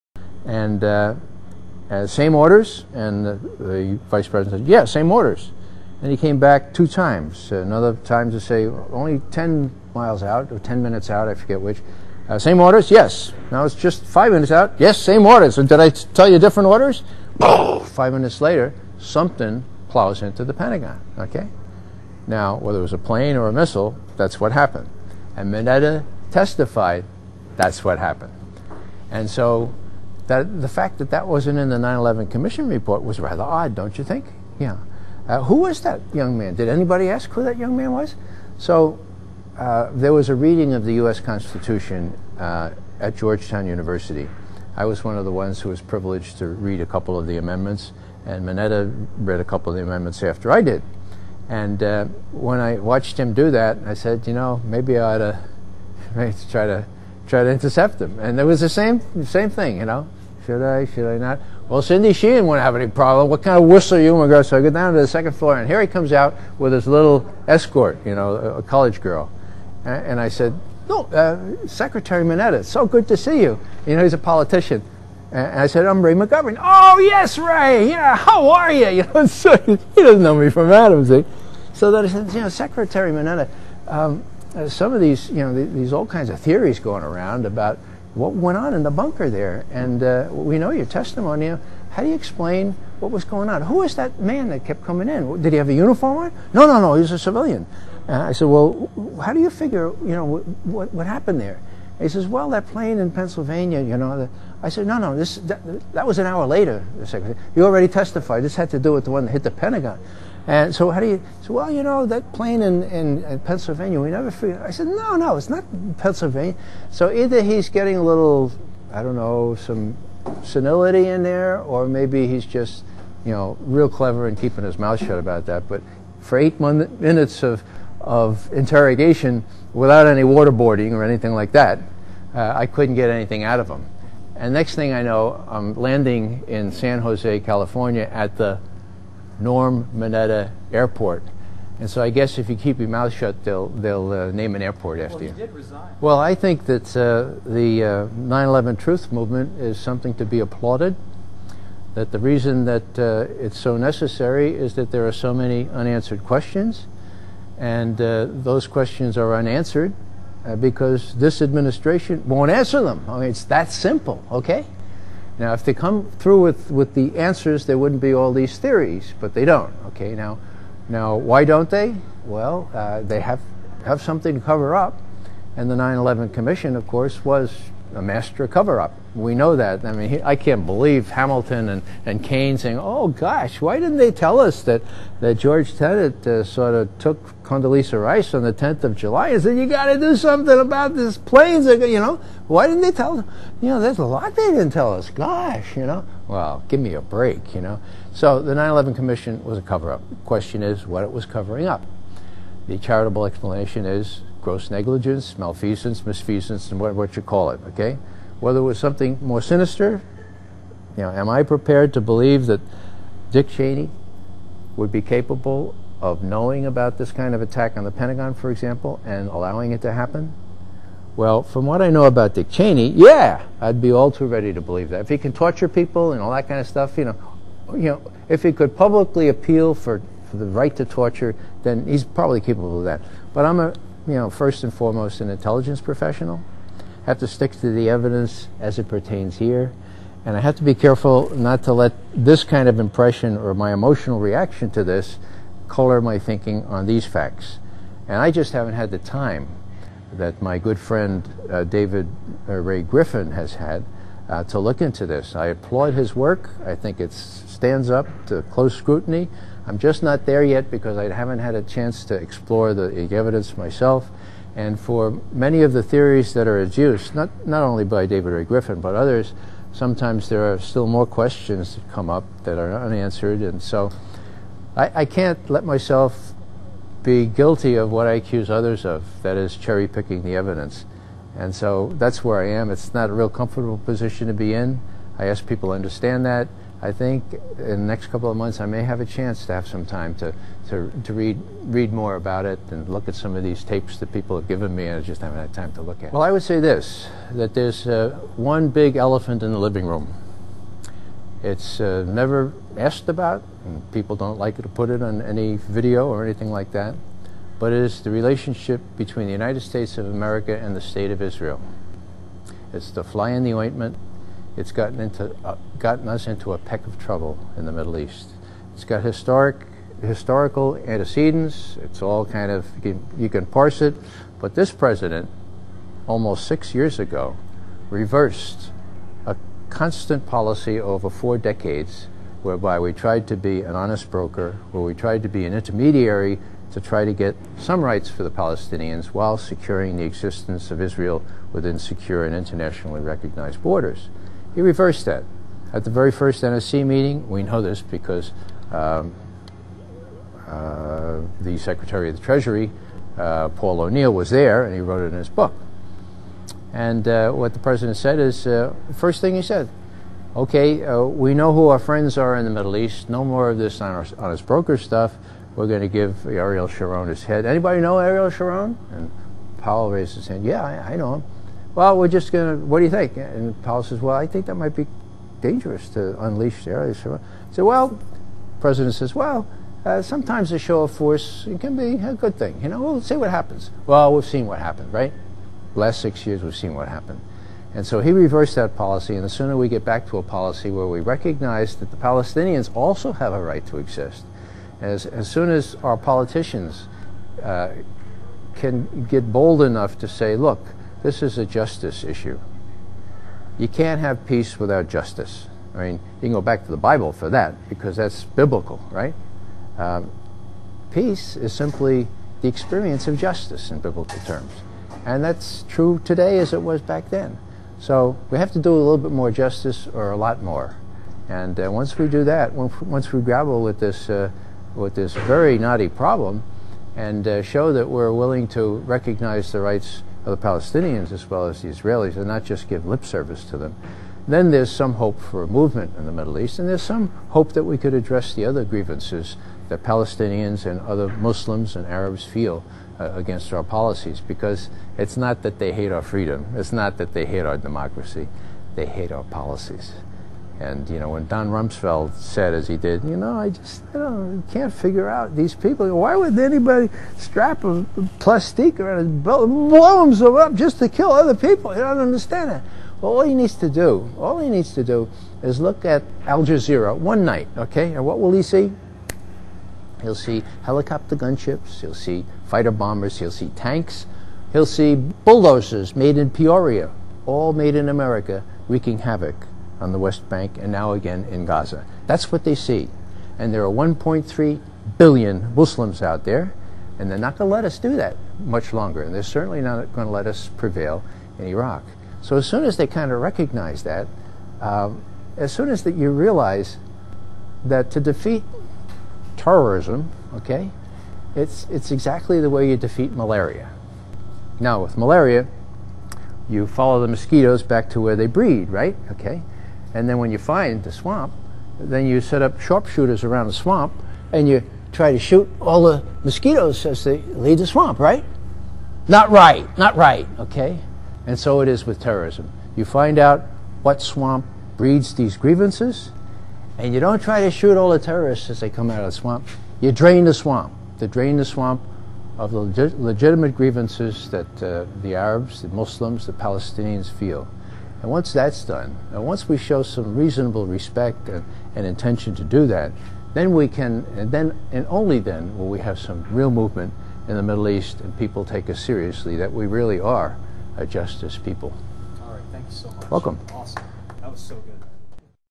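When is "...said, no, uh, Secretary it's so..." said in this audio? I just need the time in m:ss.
1:10.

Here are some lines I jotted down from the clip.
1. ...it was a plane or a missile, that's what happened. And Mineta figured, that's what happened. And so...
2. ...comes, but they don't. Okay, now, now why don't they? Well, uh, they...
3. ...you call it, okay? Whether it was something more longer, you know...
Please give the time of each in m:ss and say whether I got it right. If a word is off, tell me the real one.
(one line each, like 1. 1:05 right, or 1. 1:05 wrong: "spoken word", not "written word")
1. 0:22 wrong: "testified", not "figured"
2. 2:48 wrong: "theories", not "comes"
3. 3:27 wrong: "sinister", not "longer".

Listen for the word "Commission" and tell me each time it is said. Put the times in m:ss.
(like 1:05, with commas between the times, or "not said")
0:32, 2:56, 3:18.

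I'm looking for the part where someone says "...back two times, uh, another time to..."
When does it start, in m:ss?
0:06.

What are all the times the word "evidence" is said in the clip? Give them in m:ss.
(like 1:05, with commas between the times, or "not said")
3:57, 4:23, 4:40.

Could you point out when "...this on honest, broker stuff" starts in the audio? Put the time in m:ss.
6:03.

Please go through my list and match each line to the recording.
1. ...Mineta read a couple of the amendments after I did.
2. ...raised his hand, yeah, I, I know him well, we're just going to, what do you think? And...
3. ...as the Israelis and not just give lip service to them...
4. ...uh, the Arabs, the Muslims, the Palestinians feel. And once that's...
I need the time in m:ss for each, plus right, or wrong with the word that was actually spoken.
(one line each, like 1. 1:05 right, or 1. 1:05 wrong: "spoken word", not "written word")
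1. 0:48 right
2. 6:09 right
3. 7:11 right
4. 8:54 right.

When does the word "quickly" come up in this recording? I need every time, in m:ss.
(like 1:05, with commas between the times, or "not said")
not said.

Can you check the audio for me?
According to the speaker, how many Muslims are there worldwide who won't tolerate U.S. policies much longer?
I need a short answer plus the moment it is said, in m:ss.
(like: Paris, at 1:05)
1.3 billion, at 8:03.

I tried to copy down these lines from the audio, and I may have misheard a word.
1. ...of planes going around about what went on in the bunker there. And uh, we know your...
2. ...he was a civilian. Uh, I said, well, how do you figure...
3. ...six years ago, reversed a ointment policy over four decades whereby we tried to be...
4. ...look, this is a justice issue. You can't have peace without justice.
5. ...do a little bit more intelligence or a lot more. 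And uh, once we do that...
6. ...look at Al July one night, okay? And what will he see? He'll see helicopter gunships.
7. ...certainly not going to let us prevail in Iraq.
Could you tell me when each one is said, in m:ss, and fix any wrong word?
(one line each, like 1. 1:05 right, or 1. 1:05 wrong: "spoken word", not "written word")
1. 1:26 wrong: "theories", not "planes"
2. 1:36 right
3. 5:26 wrong: "constant", not "ointment"
4. 6:40 right
5. 6:58 wrong: "justice", not "intelligence"
6. 7:45 wrong: "Jazeera", not "July"
7. 8:09 right.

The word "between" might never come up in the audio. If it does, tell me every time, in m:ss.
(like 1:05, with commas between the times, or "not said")
5:08.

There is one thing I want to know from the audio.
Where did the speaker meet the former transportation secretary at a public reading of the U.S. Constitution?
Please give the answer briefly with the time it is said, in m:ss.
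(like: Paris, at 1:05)
Georgetown University, at 0:43.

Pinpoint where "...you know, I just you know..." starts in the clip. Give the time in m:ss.
7:33.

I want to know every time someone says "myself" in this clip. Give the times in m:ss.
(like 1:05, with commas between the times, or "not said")
4:23, 4:35.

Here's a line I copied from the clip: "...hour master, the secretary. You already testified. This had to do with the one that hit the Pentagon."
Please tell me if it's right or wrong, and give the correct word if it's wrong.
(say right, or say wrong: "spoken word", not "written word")
wrong: "later", not "master".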